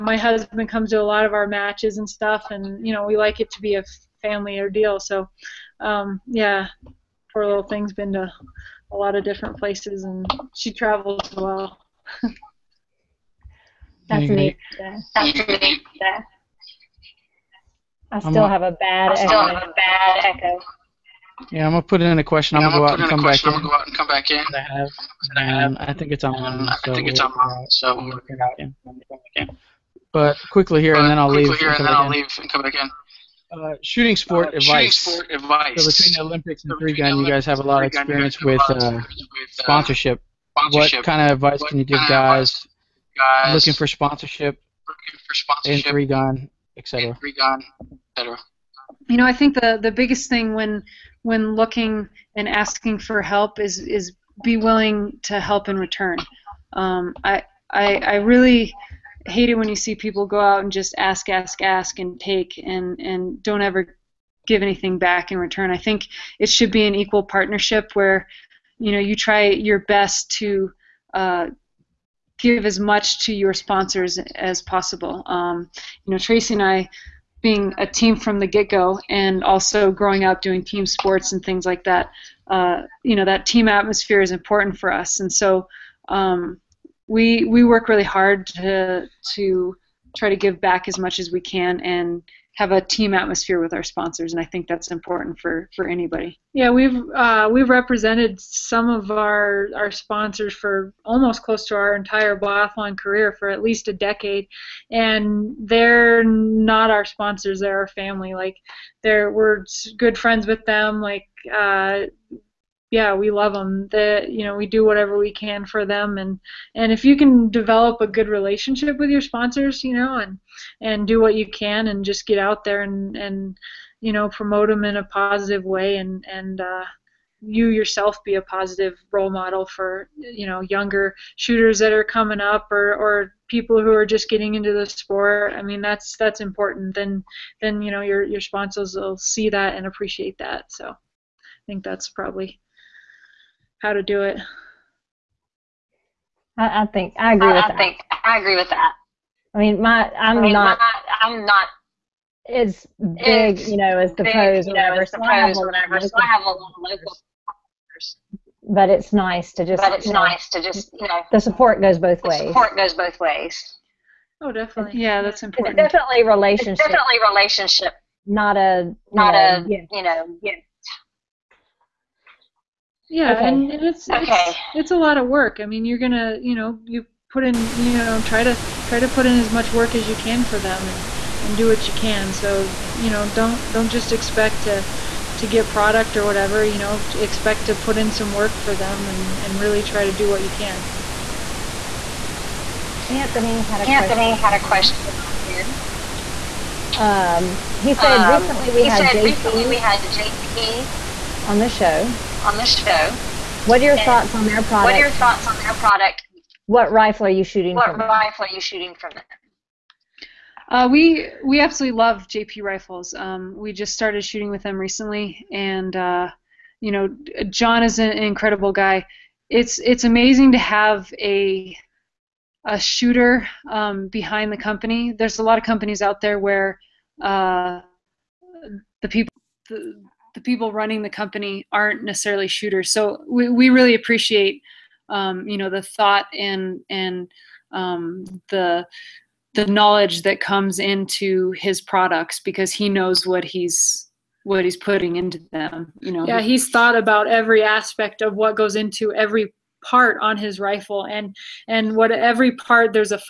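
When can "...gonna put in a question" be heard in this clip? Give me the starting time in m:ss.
0:21.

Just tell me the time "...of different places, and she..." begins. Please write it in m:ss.
0:09.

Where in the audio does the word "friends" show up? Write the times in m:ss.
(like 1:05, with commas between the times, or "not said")
1:50.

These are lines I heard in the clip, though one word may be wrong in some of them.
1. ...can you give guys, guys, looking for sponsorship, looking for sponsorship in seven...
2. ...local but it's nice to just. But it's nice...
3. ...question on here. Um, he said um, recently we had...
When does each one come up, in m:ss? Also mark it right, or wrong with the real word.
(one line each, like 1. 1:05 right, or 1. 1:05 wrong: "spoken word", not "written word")
1. 0:41 wrong: "three", not "seven"
2. 2:36 right
3. 3:14 right.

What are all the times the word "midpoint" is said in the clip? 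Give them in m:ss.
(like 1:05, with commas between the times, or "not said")
not said.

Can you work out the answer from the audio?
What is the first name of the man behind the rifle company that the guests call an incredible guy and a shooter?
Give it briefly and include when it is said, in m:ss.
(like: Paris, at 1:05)
John, at 3:37.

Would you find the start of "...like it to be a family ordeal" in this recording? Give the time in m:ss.
0:03.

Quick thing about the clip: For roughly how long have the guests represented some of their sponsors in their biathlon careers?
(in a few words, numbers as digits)
A decade.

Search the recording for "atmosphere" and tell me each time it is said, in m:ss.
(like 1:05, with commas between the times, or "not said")
1:23, 1:33.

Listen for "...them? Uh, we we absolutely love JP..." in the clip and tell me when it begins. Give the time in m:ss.
3:29.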